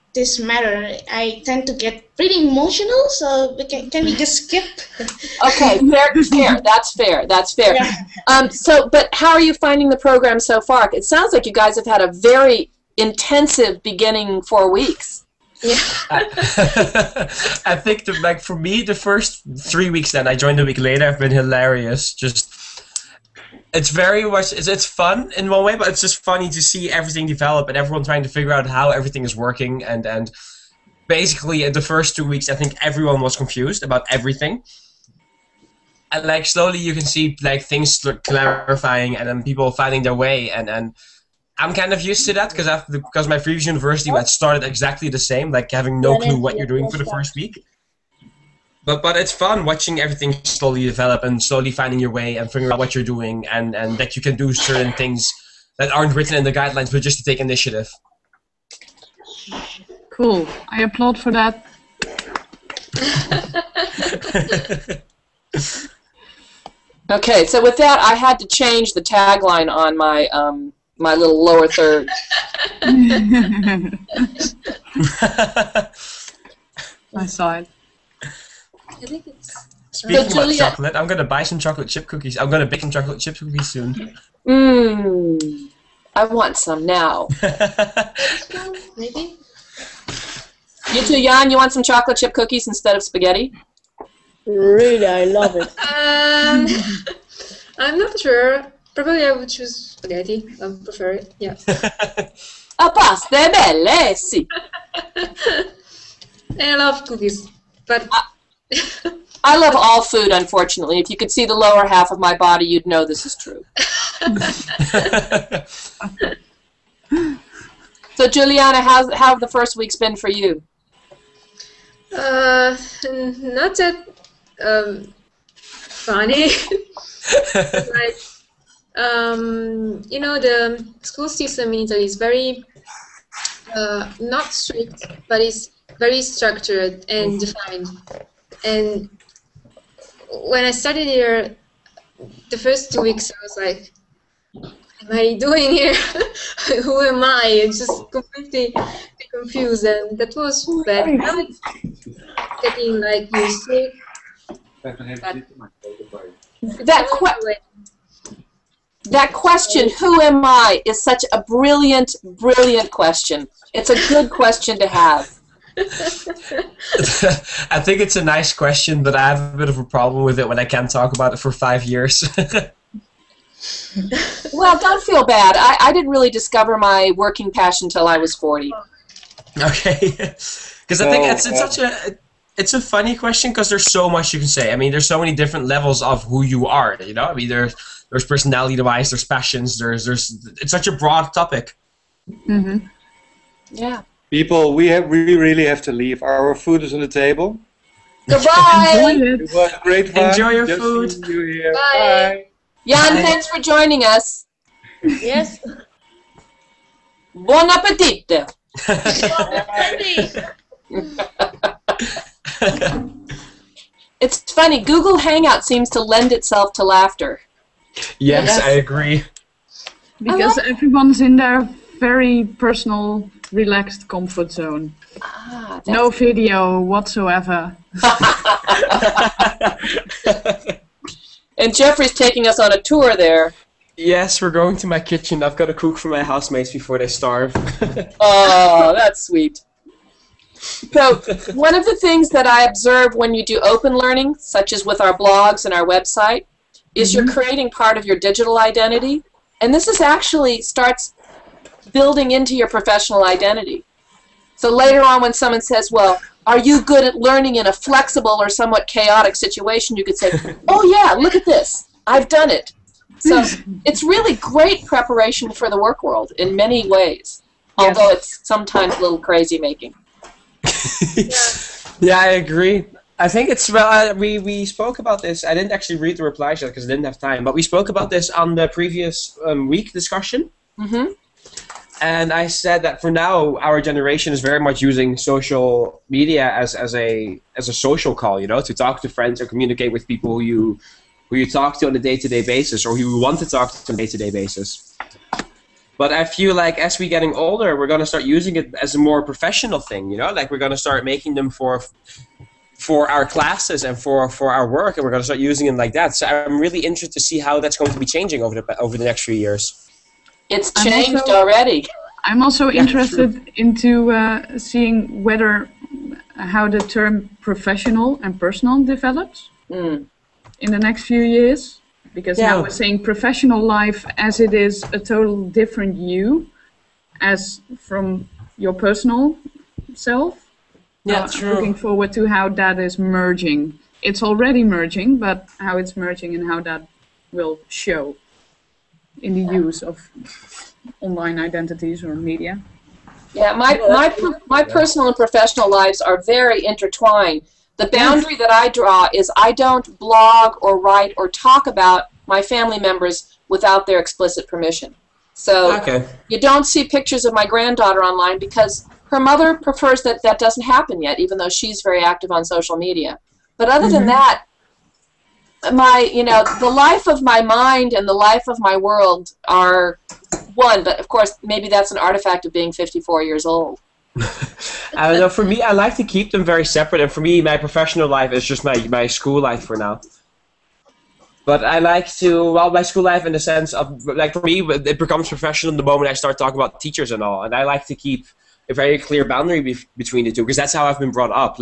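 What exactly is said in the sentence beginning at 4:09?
And this is actually starts building into your professional identity.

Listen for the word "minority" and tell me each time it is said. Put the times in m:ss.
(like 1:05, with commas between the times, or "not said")
not said.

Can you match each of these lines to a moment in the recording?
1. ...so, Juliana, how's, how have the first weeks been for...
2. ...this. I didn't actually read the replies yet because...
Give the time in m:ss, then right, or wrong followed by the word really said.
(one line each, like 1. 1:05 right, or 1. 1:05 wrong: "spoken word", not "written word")
1. 1:58 right
2. 4:35 right.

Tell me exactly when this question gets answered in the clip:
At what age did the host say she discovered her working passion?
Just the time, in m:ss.
2:58.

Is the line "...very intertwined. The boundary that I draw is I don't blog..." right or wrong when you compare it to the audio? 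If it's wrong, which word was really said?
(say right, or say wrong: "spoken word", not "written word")
right.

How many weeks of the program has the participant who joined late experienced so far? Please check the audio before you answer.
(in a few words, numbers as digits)
3.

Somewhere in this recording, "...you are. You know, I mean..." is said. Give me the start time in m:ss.
3:06.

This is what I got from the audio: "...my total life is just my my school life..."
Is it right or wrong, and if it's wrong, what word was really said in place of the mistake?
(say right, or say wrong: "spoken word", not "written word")
wrong: "professional", not "total".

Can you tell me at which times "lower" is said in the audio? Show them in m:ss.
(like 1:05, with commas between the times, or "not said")
1:11, 1:51.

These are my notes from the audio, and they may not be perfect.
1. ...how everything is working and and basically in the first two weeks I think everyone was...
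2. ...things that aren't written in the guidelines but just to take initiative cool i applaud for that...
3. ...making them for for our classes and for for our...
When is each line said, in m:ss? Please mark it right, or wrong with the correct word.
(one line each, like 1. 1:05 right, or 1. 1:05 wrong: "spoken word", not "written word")
1. 0:28 right
2. 0:54 right
3. 5:01 right.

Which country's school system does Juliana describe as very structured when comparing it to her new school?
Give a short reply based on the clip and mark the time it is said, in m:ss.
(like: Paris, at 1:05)
Italy, at 2:11.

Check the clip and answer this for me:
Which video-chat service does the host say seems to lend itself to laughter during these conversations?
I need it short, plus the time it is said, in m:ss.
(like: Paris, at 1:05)
Google Hangout, at 3:34.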